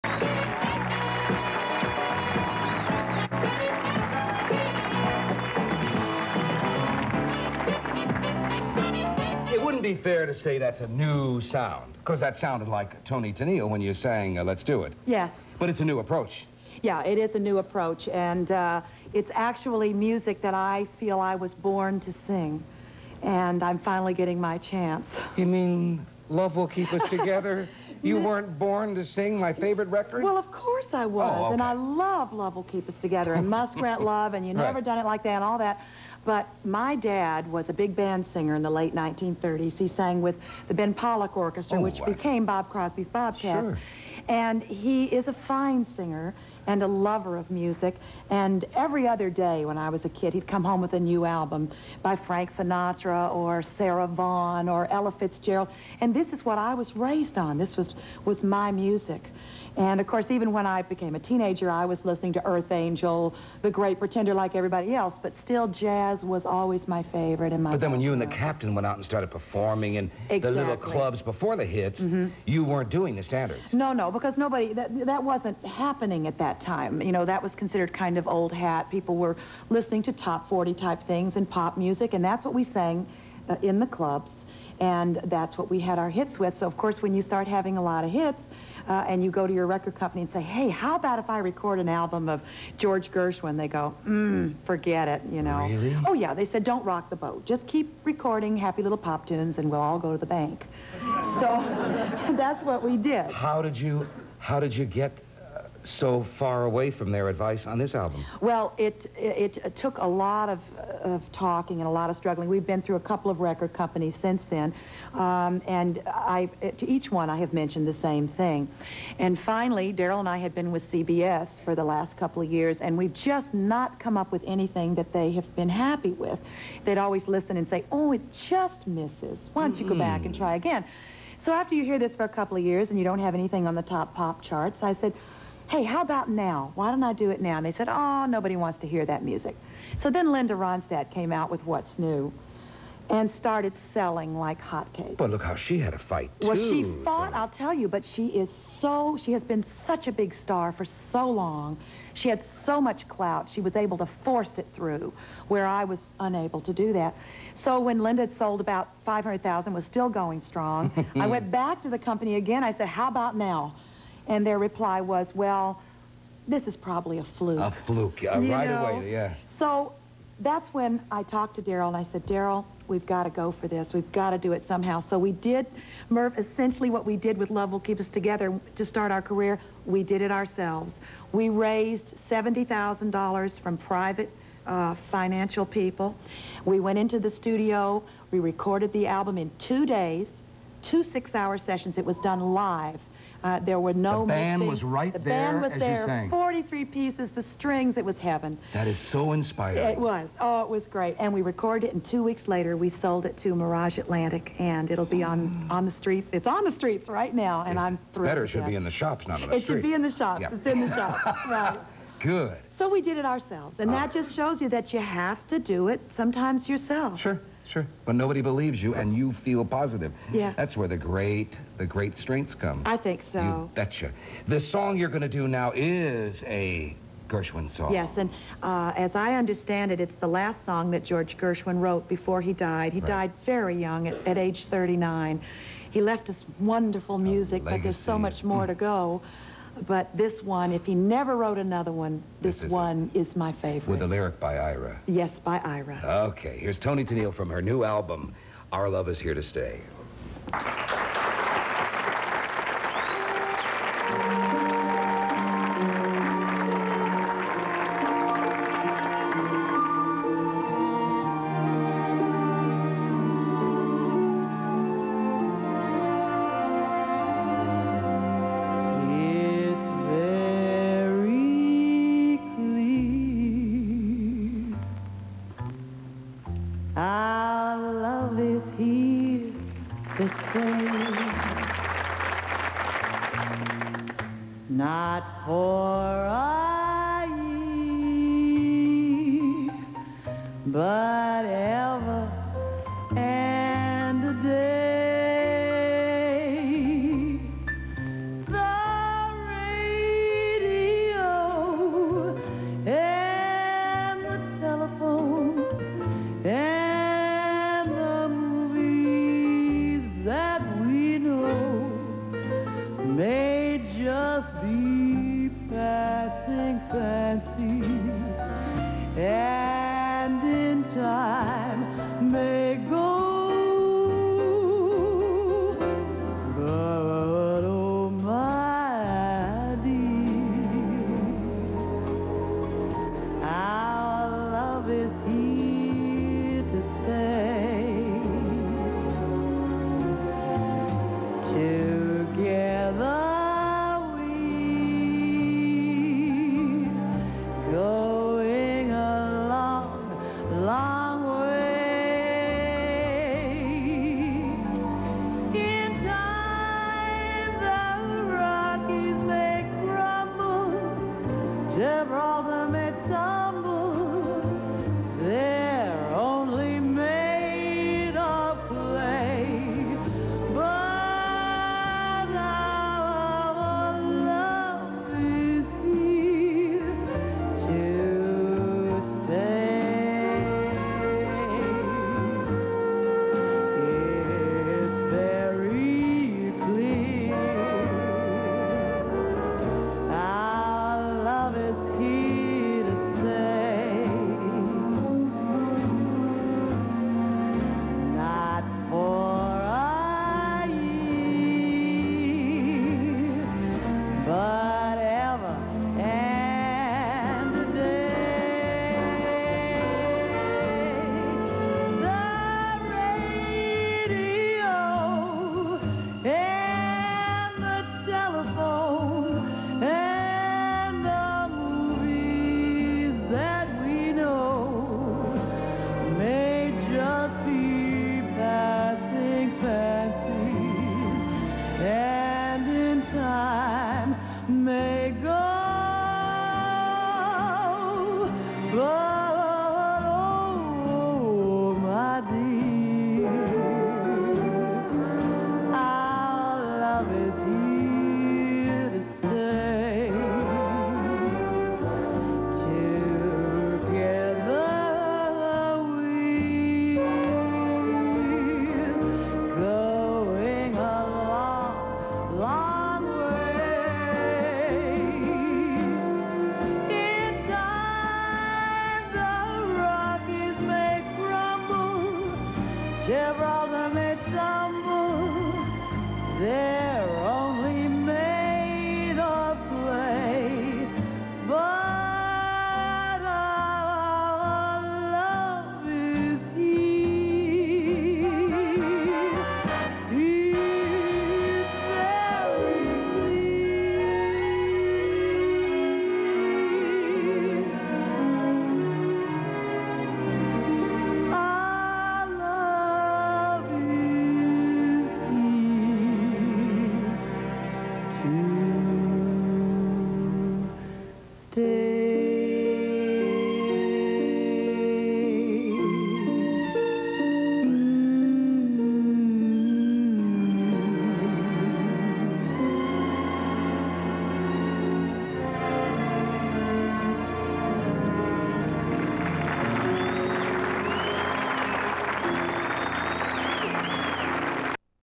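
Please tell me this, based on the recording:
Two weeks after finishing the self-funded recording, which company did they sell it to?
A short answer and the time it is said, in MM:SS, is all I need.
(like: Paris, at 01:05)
Mirage Atlantic, at 03:23.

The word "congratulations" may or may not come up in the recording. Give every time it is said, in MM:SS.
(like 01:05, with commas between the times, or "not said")
not said.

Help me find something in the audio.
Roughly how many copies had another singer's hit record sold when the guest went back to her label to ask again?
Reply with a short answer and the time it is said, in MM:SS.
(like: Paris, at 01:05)
500,000, at 02:39.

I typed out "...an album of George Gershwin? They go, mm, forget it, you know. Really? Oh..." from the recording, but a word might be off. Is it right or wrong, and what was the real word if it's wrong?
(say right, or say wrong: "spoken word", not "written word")
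right.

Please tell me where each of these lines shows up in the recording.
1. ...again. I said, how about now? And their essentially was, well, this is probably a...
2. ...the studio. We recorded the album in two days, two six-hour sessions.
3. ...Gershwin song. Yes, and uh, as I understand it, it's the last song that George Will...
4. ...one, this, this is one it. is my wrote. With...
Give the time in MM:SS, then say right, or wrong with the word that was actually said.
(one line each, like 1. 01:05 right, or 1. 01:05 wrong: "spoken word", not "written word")
1. 02:42 wrong: "reply", not "essentially"
2. 03:07 right
3. 03:47 wrong: "Gershwin", not "Will"
4. 04:01 wrong: "favorite", not "wrote".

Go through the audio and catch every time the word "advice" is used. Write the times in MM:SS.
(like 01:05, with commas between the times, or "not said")
01:47.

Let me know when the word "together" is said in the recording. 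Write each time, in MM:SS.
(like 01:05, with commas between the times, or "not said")
00:27, 00:33, 02:58.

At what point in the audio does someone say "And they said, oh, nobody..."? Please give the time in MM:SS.
02:17.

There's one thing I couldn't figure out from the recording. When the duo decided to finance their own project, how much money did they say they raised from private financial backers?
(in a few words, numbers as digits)
$70,000.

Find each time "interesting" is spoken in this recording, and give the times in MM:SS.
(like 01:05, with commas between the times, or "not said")
not said.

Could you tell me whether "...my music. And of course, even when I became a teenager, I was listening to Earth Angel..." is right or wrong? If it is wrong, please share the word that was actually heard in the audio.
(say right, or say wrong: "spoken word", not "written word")
right.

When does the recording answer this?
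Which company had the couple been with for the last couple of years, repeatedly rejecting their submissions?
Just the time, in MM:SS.
02:00.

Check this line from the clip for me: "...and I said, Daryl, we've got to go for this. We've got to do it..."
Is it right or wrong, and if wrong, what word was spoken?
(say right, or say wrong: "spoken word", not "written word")
right.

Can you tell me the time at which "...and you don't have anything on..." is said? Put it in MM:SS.
02:12.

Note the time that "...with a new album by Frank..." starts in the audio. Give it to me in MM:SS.
00:50.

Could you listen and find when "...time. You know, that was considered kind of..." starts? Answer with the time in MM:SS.
01:16.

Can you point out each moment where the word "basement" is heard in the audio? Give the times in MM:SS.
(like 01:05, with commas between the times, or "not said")
not said.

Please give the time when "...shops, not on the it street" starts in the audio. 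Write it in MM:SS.
03:28.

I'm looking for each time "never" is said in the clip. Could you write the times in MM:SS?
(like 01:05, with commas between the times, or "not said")
00:34, 04:00.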